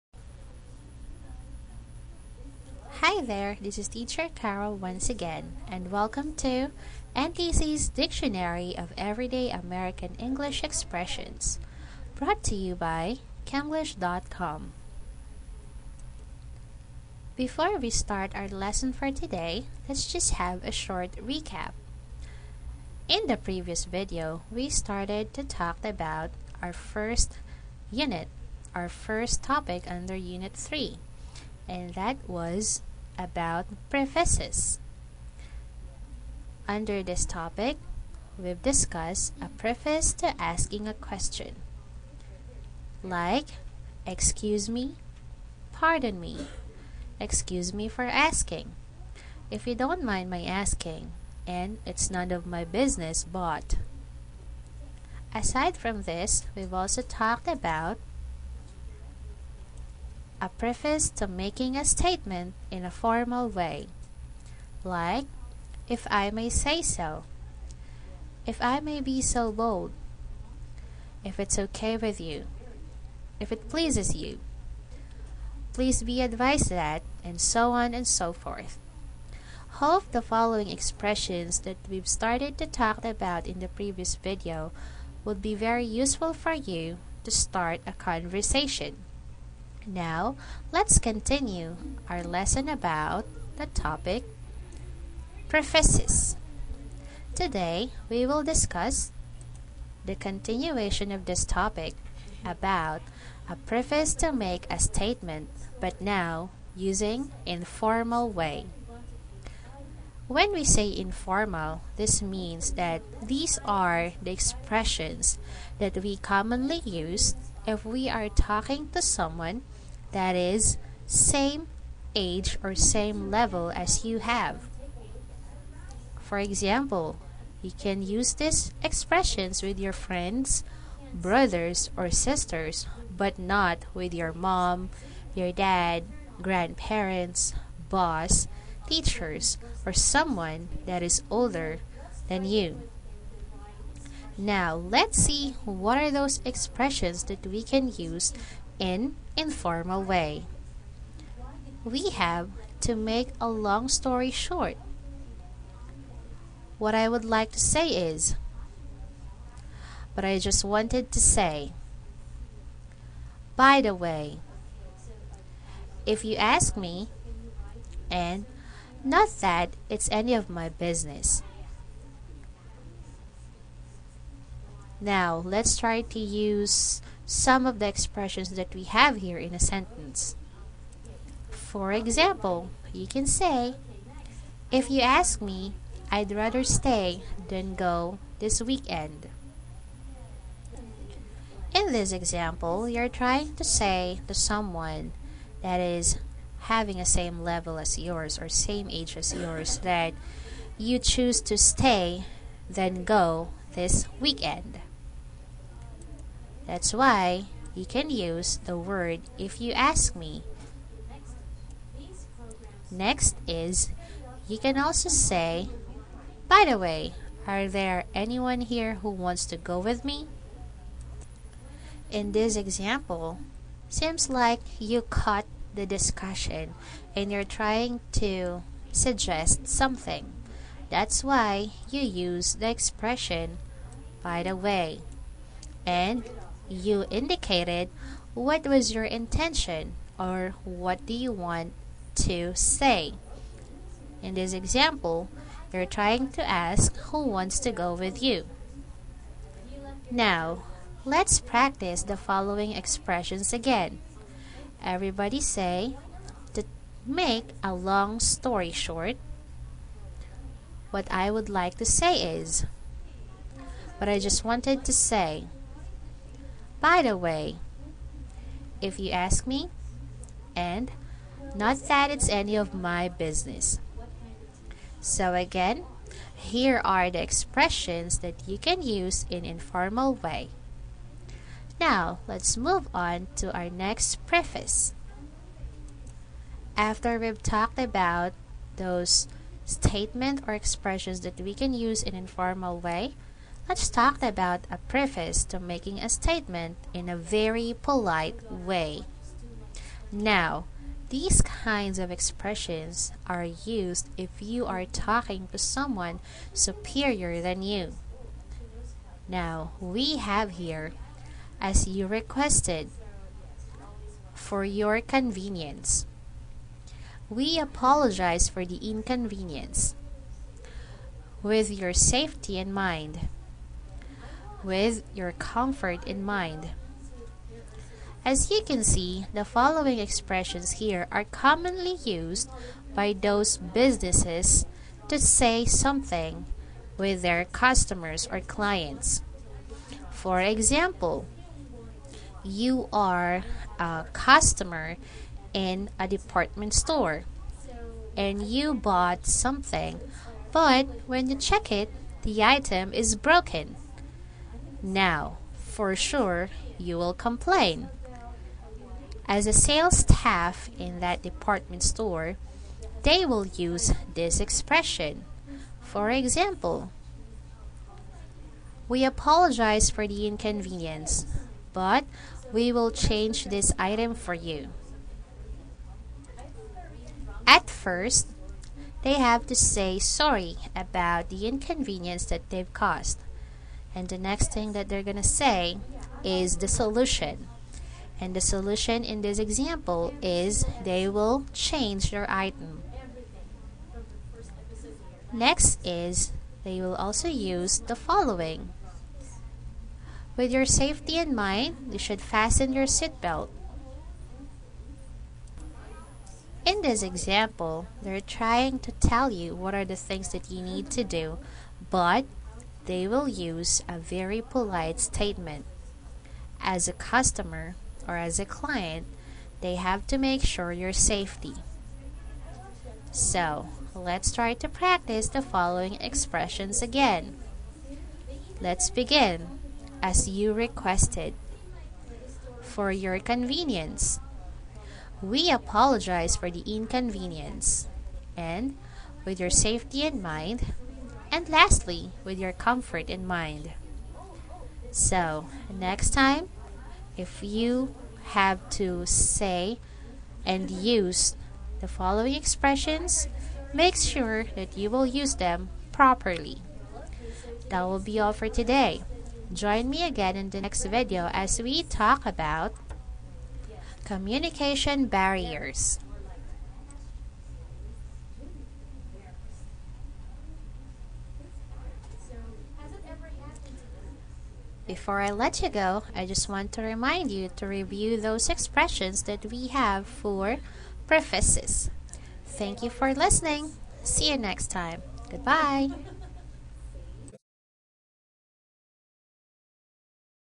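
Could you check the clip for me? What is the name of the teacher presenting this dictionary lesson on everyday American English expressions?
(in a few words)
Carol.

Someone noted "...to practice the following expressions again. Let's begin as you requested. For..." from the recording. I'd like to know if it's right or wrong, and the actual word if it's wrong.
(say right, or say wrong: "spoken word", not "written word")
right.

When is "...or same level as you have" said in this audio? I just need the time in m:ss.
2:02.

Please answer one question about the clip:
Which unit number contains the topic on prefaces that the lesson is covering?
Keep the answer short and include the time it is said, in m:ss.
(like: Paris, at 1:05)
3, at 0:30.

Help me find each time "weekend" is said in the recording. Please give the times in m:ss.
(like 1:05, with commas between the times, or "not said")
3:08, 3:24.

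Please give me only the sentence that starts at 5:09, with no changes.
Now, we have here, as you requested, for your convenience.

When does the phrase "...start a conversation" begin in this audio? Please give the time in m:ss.
1:27.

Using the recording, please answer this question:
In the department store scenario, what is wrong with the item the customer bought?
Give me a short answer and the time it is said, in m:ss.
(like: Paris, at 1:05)
broken, at 5:53.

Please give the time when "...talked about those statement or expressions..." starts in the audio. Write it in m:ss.
4:47.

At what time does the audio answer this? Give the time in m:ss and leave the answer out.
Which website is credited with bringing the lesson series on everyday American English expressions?
0:13.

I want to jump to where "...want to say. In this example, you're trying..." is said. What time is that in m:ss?
4:01.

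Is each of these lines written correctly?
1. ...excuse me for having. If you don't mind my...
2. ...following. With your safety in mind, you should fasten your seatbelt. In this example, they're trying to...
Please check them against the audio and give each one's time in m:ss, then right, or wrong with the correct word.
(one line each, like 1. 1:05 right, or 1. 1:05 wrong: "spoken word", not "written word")
1. 0:47 wrong: "asking", not "having"
2. 6:37 right.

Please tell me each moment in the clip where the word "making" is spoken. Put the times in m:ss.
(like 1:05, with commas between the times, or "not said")
1:01, 4:55.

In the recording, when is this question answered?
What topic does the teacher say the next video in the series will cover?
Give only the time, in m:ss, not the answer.
7:44.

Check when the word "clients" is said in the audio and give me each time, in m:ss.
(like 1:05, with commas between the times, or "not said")
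5:38, 6:58.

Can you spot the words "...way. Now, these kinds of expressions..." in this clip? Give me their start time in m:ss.
4:58.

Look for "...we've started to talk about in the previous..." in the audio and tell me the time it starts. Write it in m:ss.
1:21.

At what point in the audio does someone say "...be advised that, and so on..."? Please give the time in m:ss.
1:16.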